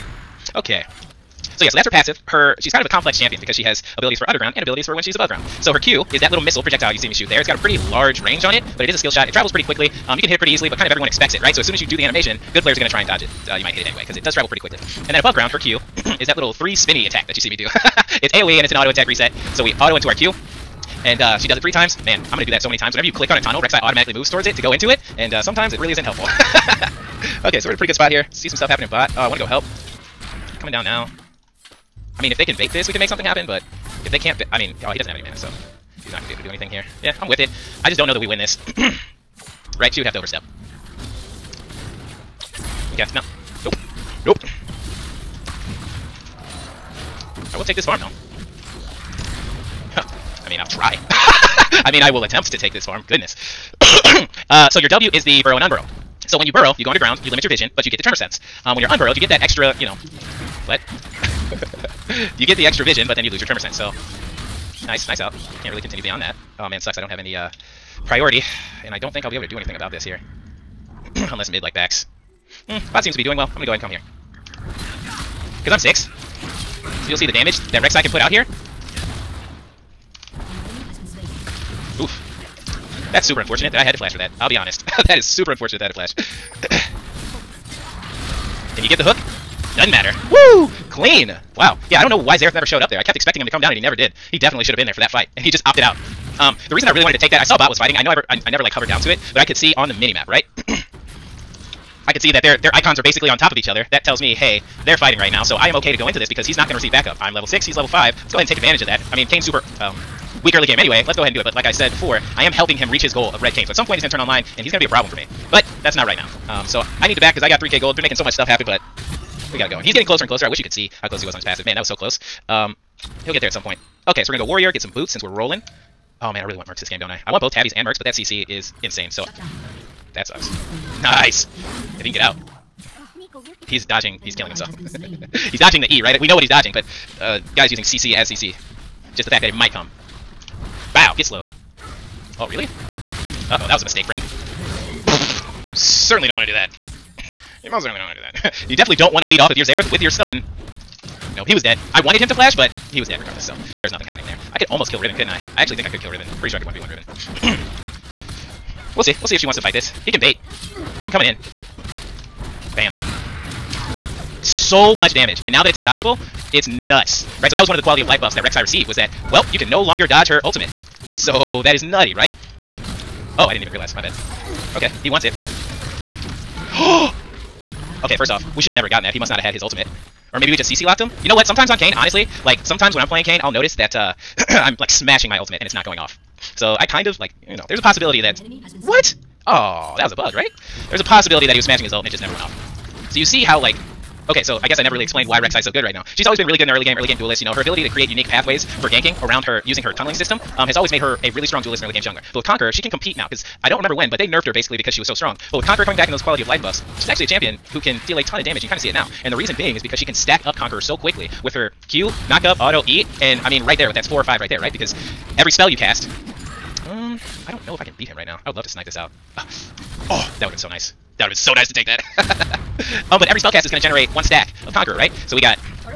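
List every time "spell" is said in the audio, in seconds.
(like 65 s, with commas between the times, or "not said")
215 s, 223 s.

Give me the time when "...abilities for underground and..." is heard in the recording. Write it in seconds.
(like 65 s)
3 s.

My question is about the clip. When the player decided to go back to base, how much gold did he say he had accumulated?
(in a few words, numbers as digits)
3k.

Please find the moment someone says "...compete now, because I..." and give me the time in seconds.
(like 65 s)
202 s.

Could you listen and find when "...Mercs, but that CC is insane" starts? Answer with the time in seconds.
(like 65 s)
127 s.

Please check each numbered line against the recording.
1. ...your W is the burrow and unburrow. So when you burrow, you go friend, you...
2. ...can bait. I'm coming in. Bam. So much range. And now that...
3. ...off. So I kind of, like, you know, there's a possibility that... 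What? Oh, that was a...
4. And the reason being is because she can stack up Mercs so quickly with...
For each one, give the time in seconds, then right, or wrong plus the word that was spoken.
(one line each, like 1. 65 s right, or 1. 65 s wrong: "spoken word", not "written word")
1. 54 s wrong: "underground", not "friend"
2. 160 s wrong: "damage", not "range"
3. 185 s right
4. 209 s wrong: "Conqueror", not "Mercs".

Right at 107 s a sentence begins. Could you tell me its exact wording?
I'm level 6, he's level 5.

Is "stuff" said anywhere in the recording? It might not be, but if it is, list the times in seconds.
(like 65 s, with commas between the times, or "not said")
28 s, 118 s.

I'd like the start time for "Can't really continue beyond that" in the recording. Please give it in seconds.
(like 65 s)
65 s.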